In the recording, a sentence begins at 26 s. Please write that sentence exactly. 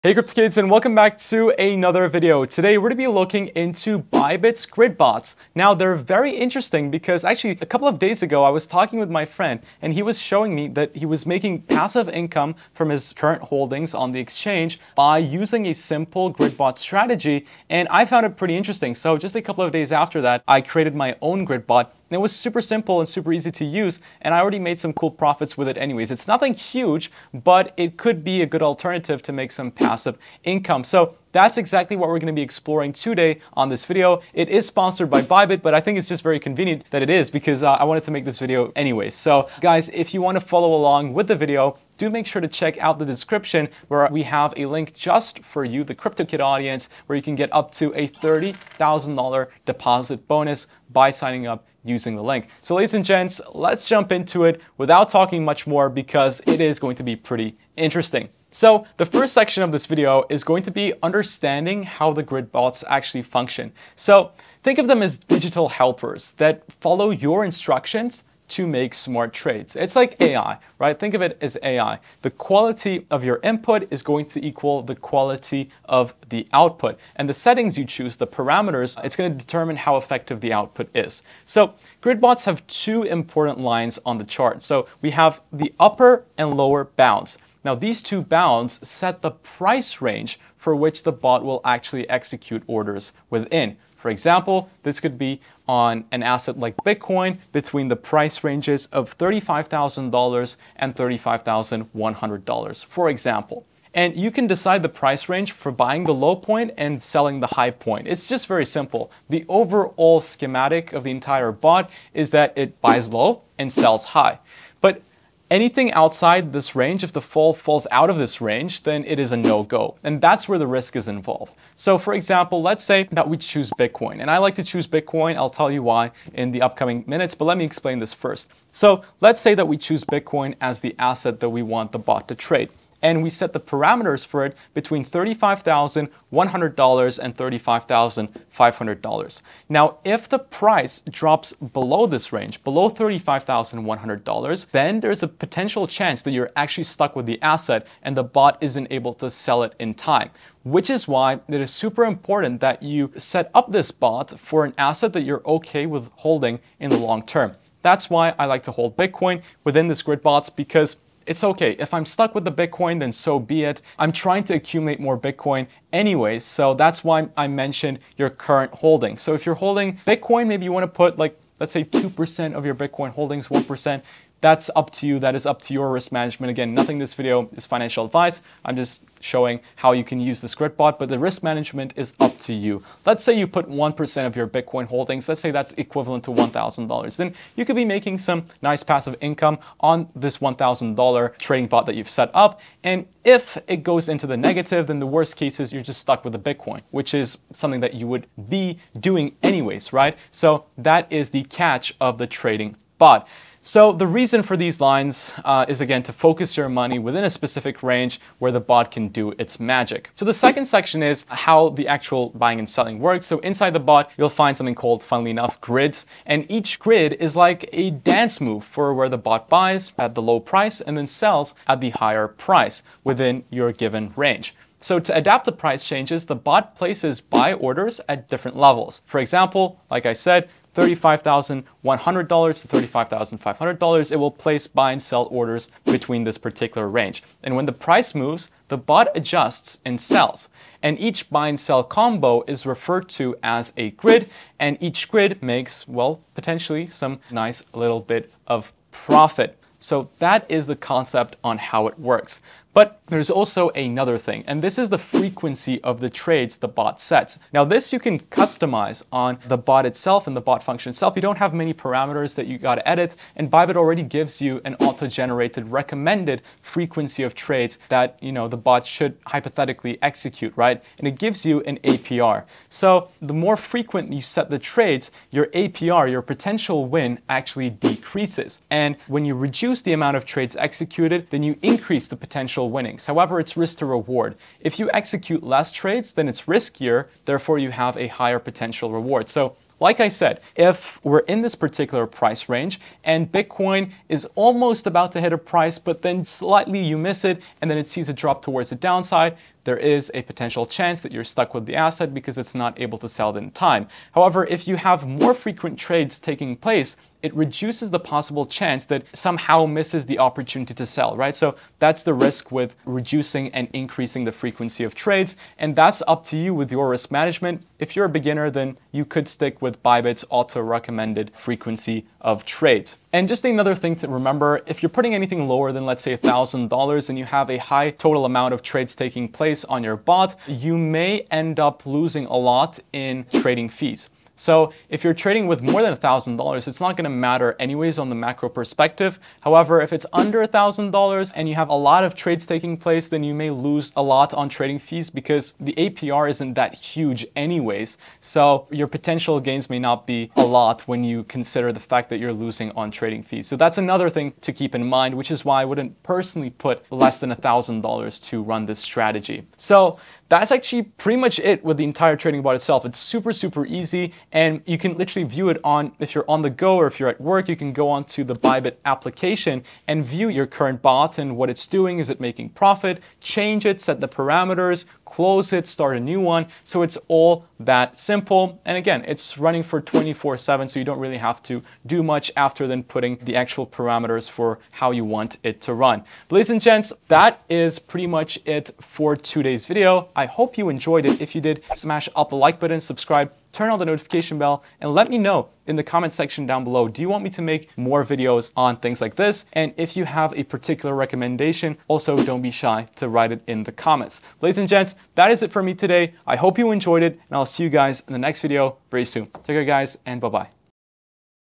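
It's nothing huge, but it could be a good alternative to make some passive income.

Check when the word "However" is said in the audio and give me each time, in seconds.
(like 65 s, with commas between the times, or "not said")
283 s, 304 s, 339 s.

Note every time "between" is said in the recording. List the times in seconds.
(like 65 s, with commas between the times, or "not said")
97 s, 134 s, 235 s.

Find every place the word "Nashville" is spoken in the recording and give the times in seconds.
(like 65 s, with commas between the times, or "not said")
not said.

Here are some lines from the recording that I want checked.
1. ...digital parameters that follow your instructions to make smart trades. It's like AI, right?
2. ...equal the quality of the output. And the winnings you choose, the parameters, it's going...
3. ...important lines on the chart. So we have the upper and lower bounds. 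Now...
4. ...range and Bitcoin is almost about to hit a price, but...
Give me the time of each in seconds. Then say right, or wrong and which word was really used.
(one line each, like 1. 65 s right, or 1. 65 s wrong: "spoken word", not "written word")
1. 65 s wrong: "helpers", not "parameters"
2. 74 s wrong: "settings", not "winnings"
3. 83 s right
4. 292 s right.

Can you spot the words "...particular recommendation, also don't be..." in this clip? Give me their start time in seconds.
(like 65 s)
400 s.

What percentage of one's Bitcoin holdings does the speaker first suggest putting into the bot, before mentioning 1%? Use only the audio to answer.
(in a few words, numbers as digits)
2%.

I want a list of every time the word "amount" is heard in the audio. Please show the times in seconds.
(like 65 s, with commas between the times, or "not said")
279 s, 328 s.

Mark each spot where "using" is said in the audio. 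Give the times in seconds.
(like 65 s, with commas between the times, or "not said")
15 s, 51 s.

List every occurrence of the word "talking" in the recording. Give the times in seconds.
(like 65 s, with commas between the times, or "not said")
8 s, 55 s.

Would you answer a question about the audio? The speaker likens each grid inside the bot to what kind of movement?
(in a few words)
a dance move.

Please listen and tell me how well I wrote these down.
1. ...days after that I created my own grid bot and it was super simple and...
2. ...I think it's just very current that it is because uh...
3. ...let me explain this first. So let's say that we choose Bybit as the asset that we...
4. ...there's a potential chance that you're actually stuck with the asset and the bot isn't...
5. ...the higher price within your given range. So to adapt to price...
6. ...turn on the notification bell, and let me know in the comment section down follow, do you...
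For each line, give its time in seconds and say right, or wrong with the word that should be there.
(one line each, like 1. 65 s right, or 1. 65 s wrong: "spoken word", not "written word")
1. 19 s right
2. 35 s wrong: "convenient", not "current"
3. 127 s wrong: "Bitcoin", not "Bybit"
4. 145 s right
5. 221 s right
6. 393 s wrong: "below", not "follow".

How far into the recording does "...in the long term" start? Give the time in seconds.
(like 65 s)
156 s.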